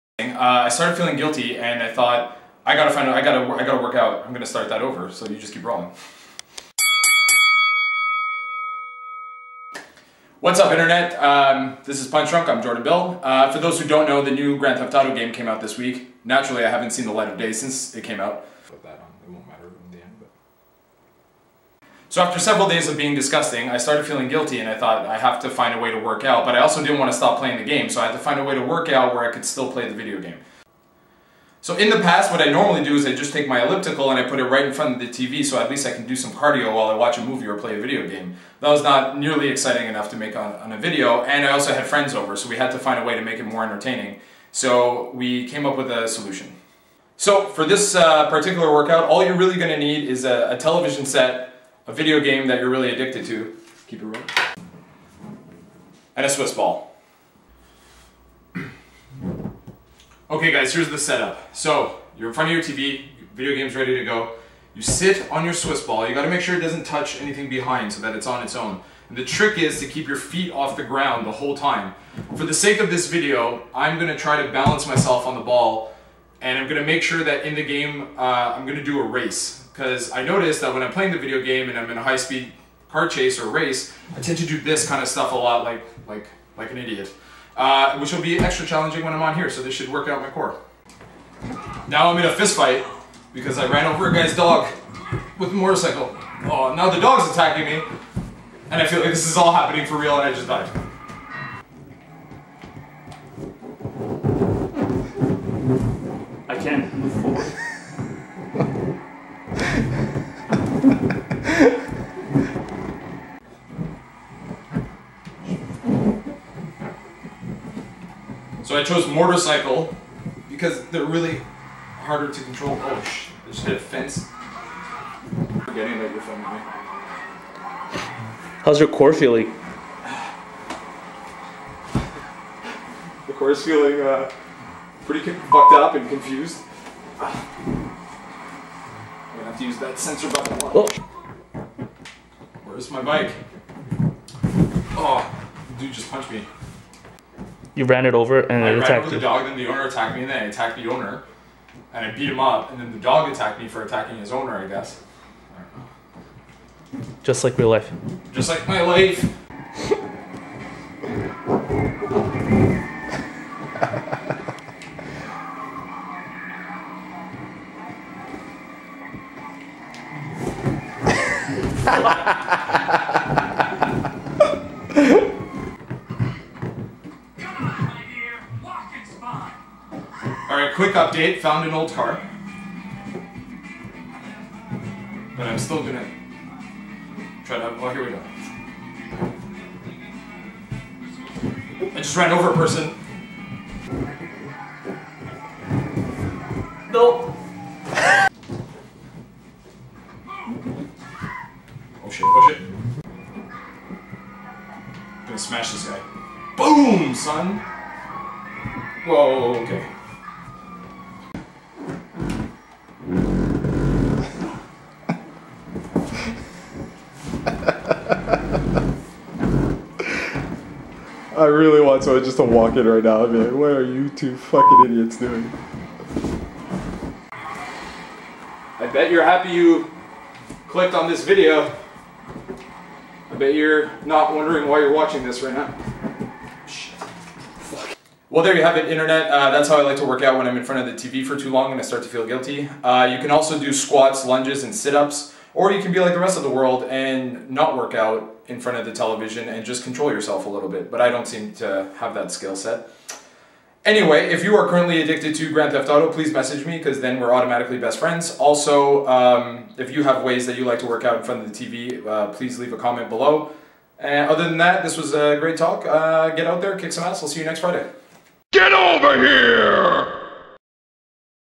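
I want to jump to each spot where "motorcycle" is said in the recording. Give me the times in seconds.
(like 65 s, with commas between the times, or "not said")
95 s, 119 s.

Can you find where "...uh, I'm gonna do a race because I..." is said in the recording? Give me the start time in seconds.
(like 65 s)
78 s.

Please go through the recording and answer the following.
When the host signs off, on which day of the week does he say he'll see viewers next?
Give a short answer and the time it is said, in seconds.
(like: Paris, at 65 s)
Friday, at 267 s.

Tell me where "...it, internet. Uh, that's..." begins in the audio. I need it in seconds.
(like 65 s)
238 s.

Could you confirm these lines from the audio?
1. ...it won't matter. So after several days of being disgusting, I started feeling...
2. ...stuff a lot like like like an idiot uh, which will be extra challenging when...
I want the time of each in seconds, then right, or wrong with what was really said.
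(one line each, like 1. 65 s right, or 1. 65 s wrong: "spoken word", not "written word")
1. 19 s right
2. 85 s right.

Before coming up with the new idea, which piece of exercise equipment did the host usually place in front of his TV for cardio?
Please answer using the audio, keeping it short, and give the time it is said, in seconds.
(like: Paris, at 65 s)
elliptical, at 33 s.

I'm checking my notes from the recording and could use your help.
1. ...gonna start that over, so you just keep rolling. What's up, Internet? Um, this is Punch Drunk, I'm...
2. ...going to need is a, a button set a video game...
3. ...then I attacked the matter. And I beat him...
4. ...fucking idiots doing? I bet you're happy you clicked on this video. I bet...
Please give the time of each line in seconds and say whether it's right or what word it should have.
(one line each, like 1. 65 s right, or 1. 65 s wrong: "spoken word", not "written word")
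1. 4 s right
2. 49 s wrong: "television", not "button"
3. 150 s wrong: "owner", not "matter"
4. 224 s right.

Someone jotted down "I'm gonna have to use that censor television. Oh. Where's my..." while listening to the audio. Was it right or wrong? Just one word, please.
wrong.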